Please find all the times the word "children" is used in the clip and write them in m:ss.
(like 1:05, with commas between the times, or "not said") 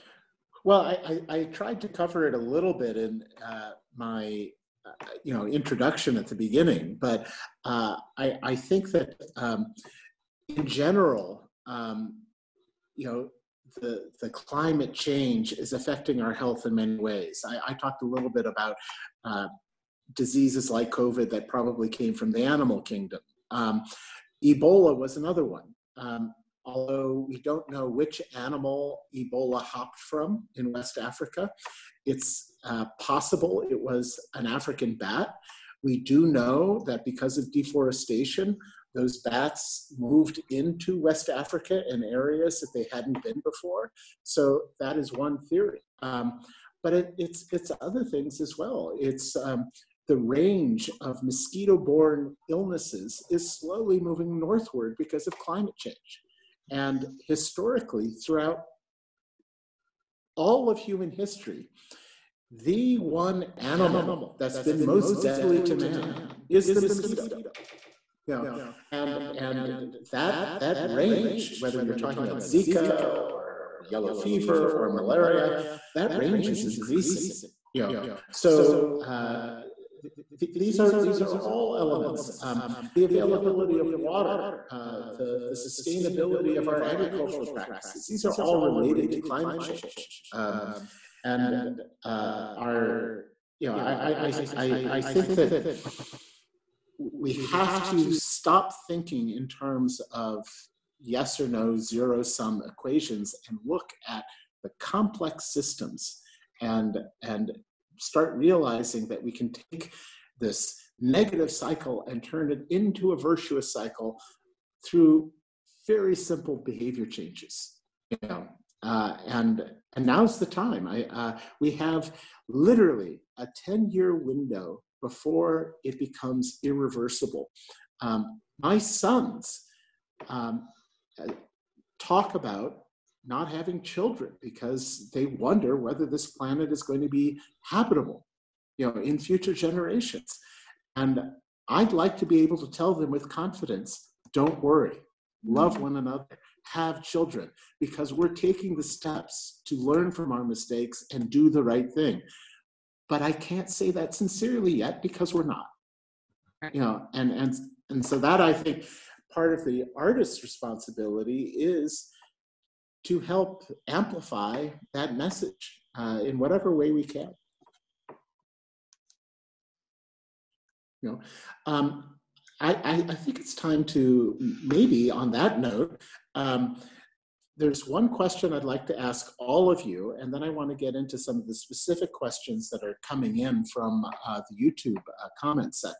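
2:13, 2:27.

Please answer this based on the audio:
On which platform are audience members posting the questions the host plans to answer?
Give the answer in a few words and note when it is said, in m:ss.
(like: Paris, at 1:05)
YouTube, at 3:04.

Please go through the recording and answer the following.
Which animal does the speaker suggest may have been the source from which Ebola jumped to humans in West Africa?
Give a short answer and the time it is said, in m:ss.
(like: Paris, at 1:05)
African bat, at 0:34.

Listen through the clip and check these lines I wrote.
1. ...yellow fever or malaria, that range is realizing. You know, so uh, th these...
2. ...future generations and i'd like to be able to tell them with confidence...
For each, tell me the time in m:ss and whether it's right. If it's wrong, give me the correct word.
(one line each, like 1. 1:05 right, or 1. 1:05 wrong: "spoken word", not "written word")
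1. 1:13 wrong: "increasing", not "realizing"
2. 2:19 right.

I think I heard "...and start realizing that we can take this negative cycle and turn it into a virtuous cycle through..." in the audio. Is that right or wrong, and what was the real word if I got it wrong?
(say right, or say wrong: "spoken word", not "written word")
right.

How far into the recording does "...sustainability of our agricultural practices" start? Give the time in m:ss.
1:25.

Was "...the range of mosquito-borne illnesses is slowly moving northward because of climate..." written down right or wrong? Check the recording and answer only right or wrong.
right.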